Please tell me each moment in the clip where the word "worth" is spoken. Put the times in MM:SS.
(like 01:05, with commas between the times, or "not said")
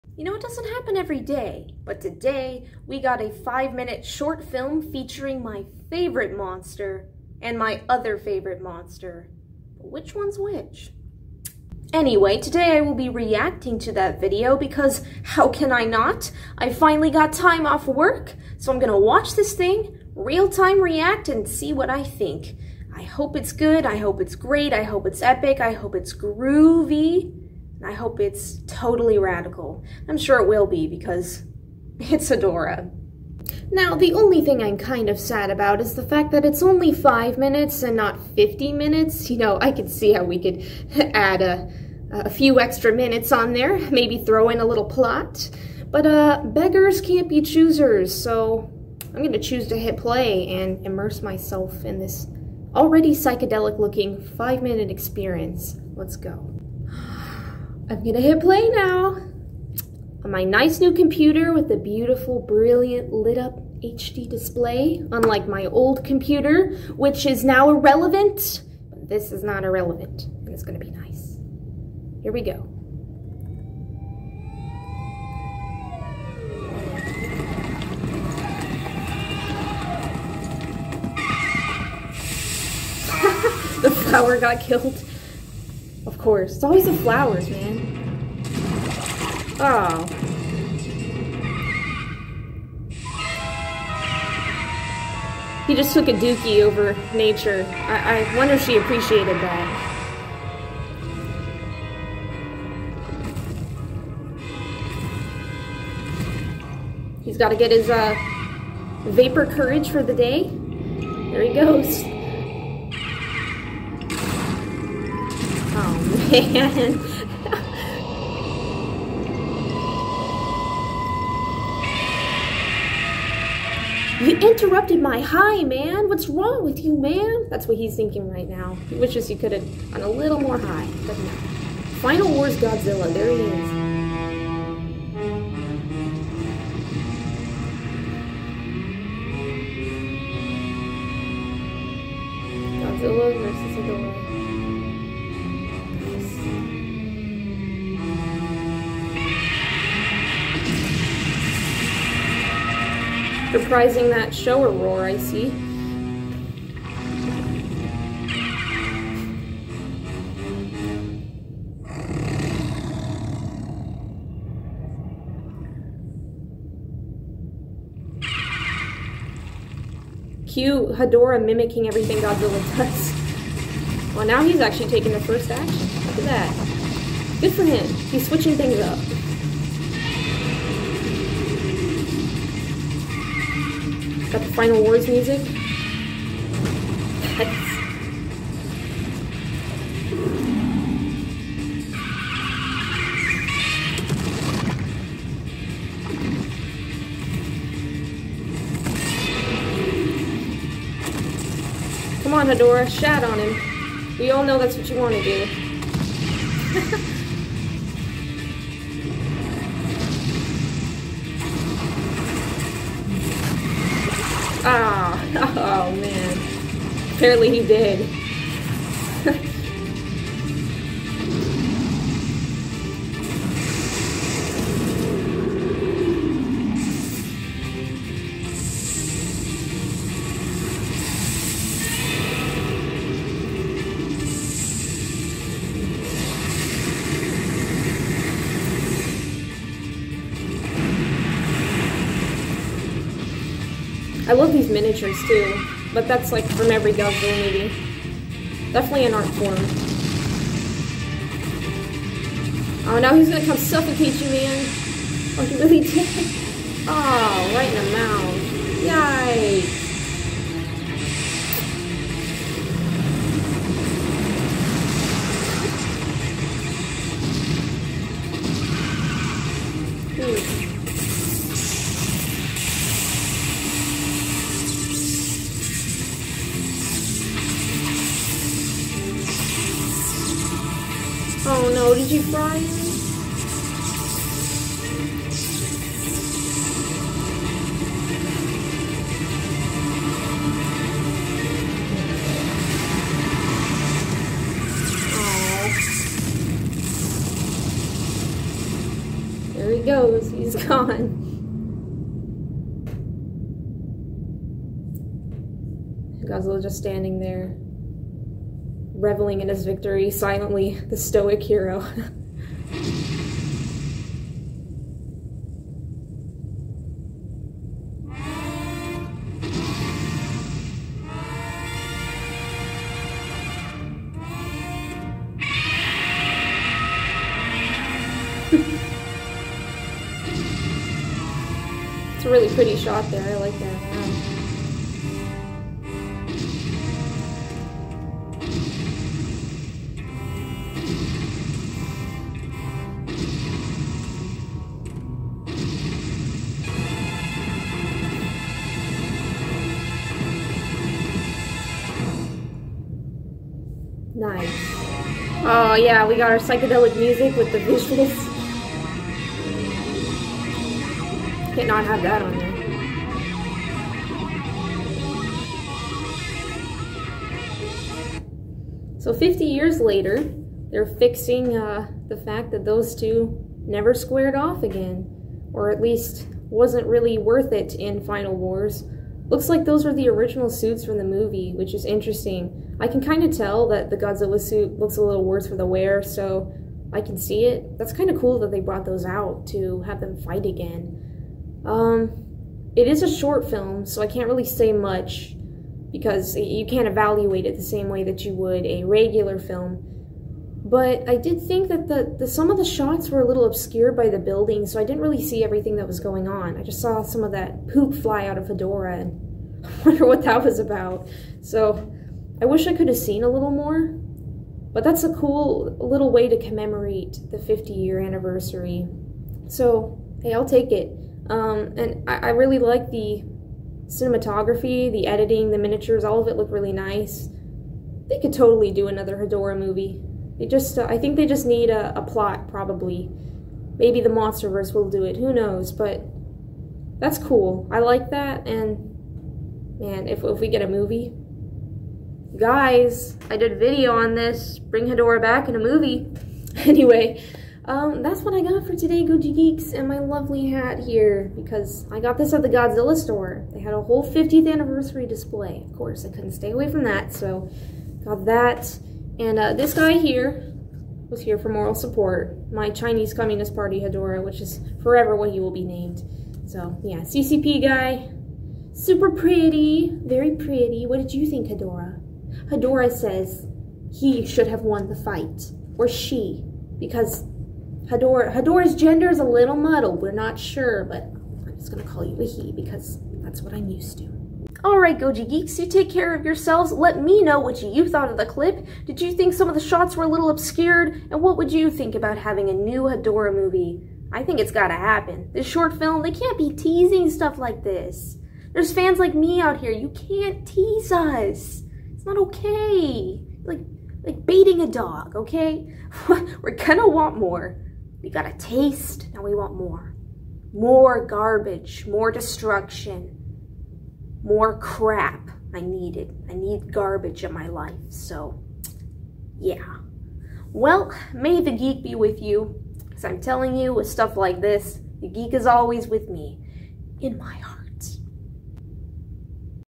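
06:17.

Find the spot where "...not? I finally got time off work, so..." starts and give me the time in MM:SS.
00:15.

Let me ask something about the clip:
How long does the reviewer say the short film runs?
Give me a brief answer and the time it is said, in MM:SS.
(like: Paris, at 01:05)
5 minutes, at 00:03.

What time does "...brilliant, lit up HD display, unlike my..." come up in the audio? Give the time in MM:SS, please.
01:02.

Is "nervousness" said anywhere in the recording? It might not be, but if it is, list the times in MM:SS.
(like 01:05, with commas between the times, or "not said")
not said.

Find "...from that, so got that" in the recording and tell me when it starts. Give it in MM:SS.
07:36.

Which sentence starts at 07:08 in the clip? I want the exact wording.
They could totally do another Hedorah movie.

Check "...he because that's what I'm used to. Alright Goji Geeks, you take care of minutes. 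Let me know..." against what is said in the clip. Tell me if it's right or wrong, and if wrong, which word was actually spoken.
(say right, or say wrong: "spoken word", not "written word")
wrong: "yourselves", not "minutes".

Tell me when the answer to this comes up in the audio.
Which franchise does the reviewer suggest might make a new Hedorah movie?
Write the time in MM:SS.
07:14.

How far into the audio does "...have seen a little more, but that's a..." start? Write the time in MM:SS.
06:52.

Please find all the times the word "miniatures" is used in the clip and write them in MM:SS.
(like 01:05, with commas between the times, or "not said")
04:04, 07:05.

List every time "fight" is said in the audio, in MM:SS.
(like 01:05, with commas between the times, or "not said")
06:30, 07:54.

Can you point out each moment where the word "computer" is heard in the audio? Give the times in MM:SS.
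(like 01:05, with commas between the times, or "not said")
01:00, 01:06.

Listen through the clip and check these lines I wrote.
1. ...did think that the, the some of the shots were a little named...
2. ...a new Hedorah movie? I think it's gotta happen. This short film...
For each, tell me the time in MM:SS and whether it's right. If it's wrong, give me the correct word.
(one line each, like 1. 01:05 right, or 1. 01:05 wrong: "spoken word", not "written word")
1. 06:41 wrong: "obscured", not "named"
2. 08:12 right.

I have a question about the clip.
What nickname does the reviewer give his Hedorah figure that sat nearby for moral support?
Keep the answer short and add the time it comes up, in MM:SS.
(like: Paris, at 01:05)
Chinese Communist Party Hedorah, at 07:42.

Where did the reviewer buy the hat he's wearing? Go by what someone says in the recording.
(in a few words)
Godzilla store.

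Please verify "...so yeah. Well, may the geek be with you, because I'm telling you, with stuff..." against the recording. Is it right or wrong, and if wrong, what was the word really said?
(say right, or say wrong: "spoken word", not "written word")
right.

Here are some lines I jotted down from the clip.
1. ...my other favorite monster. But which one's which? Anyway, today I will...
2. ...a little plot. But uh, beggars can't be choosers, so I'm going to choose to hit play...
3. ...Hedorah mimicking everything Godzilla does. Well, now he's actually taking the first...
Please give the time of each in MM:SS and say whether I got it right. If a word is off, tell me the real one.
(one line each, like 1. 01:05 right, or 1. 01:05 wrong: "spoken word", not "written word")
1. 00:07 right
2. 00:44 right
3. 02:50 right.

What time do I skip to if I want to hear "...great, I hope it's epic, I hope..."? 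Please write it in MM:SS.
00:24.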